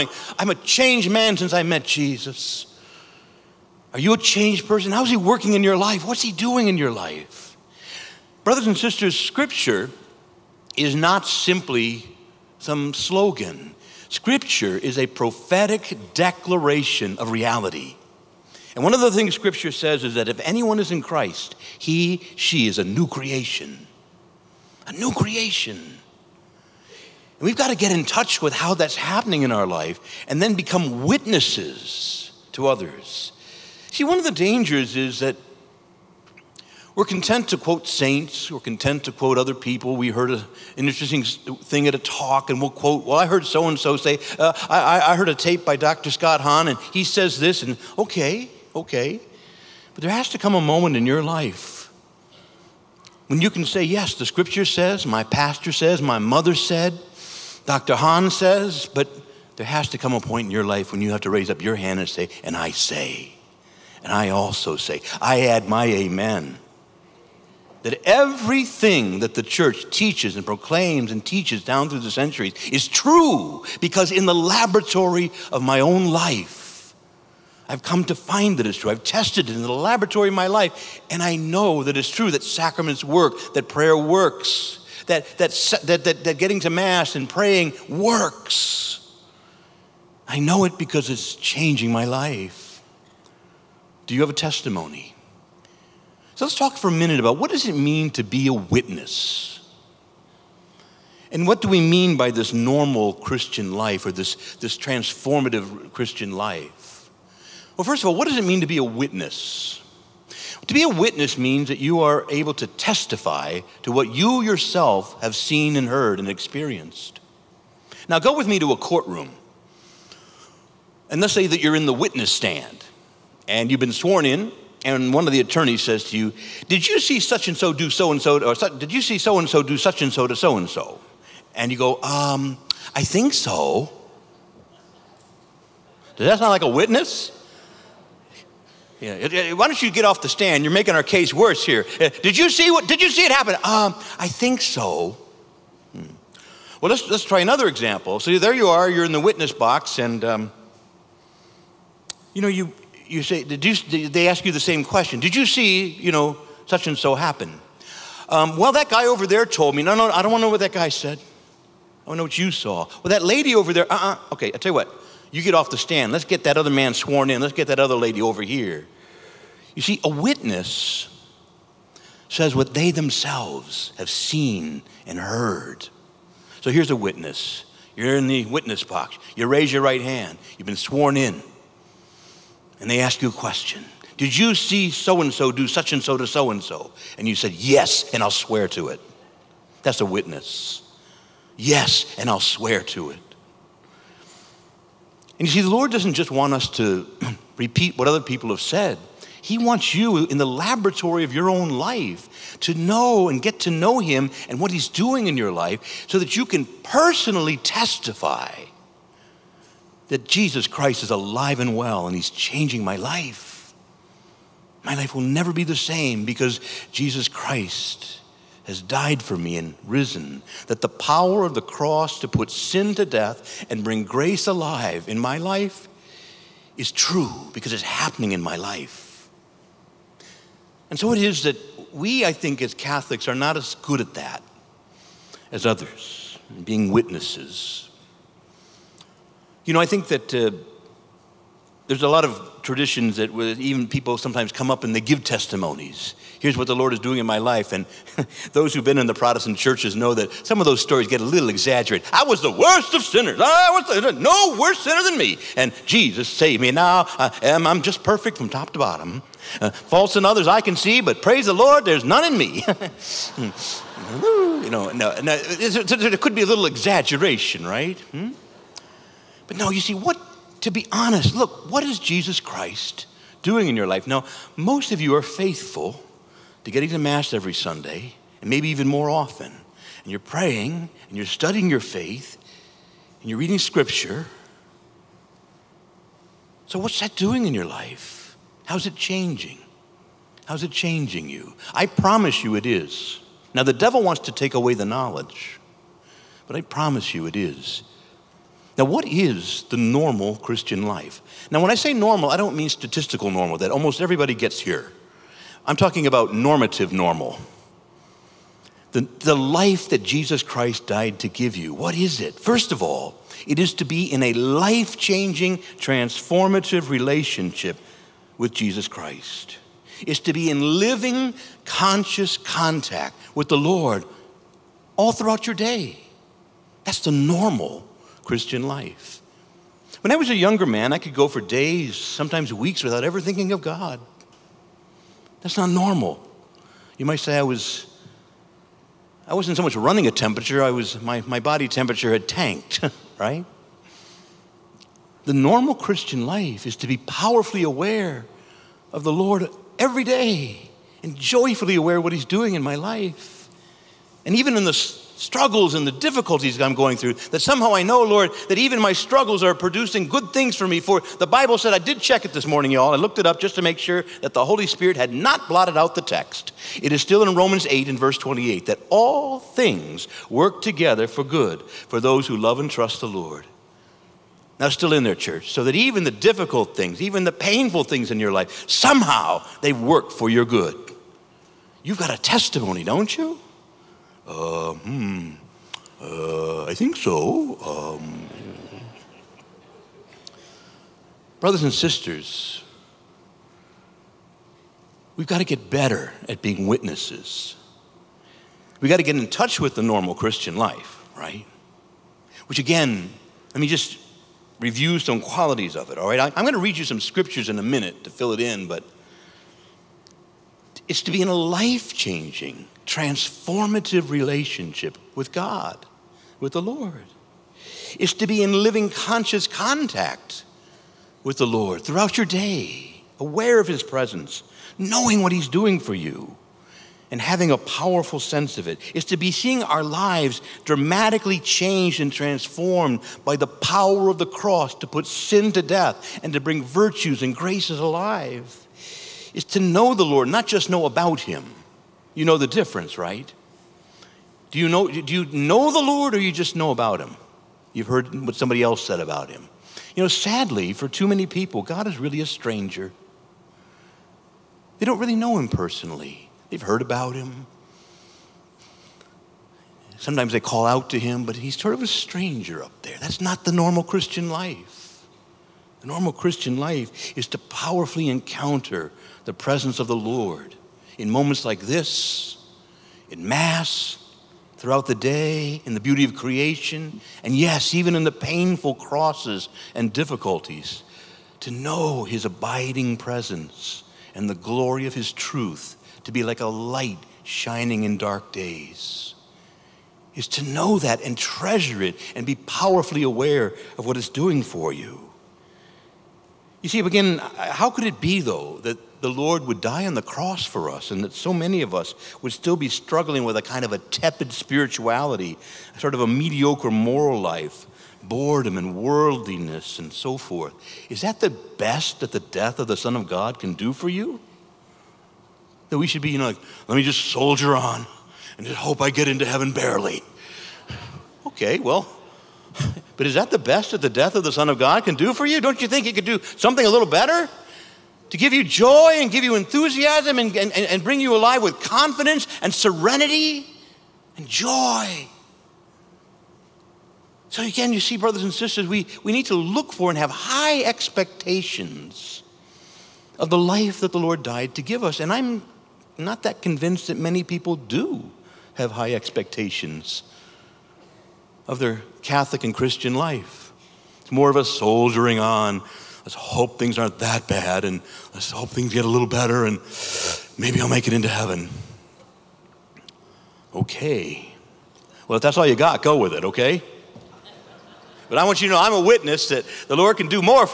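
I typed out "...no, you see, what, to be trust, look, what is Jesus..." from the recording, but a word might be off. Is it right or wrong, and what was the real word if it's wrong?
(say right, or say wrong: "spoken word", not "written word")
wrong: "honest", not "trust".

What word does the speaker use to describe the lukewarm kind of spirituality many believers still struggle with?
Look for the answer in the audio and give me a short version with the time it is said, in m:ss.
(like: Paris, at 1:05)
Tepid, at 8:23.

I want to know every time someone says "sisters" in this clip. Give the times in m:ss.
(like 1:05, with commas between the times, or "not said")
0:08, 6:31, 8:58.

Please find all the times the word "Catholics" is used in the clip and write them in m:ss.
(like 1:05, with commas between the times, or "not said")
3:52, 9:12.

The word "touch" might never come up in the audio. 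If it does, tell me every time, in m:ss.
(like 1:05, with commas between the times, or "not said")
0:28, 6:39.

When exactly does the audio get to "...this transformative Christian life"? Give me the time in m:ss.
1:44.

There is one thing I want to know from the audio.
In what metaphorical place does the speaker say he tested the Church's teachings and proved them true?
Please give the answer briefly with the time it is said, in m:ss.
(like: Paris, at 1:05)
Laboratory of my life, at 1:14.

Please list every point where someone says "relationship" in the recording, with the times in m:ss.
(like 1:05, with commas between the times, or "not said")
5:16, 6:54.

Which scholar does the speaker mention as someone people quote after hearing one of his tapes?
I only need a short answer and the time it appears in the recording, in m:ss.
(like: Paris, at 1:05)
Dr. Scott Hahn, at 0:45.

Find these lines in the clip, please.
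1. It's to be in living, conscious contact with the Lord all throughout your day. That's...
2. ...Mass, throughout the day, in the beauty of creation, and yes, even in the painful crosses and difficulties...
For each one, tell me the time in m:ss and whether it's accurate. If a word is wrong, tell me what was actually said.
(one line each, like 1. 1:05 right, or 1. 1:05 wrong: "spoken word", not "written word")
1. 5:20 right
2. 7:53 right.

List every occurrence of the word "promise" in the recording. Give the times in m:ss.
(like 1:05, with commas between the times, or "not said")
4:51, 4:56.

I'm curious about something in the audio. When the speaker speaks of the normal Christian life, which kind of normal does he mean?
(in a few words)
Normative normal.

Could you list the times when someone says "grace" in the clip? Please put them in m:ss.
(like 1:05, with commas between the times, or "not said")
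3:44, 7:17.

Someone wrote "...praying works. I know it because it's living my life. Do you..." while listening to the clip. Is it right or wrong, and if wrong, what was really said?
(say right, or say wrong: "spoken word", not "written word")
wrong: "changing", not "living".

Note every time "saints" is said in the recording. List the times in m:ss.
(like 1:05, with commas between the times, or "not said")
0:37.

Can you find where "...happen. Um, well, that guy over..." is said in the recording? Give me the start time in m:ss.
2:37.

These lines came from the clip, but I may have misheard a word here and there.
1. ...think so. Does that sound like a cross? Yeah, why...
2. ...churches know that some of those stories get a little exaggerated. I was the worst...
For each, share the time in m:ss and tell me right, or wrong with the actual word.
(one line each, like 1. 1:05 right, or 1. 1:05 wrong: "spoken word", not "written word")
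1. 2:13 wrong: "witness", not "cross"
2. 4:09 right.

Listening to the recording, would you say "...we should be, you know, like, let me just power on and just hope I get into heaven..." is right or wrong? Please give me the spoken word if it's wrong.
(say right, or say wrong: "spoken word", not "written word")
wrong: "soldier", not "power".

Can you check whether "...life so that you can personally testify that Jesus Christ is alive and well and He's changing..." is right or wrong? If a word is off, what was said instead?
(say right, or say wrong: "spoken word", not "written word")
right.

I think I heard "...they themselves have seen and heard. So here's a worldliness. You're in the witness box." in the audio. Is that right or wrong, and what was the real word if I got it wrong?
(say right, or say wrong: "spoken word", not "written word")
wrong: "witness", not "worldliness".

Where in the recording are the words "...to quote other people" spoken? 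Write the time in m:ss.
0:39.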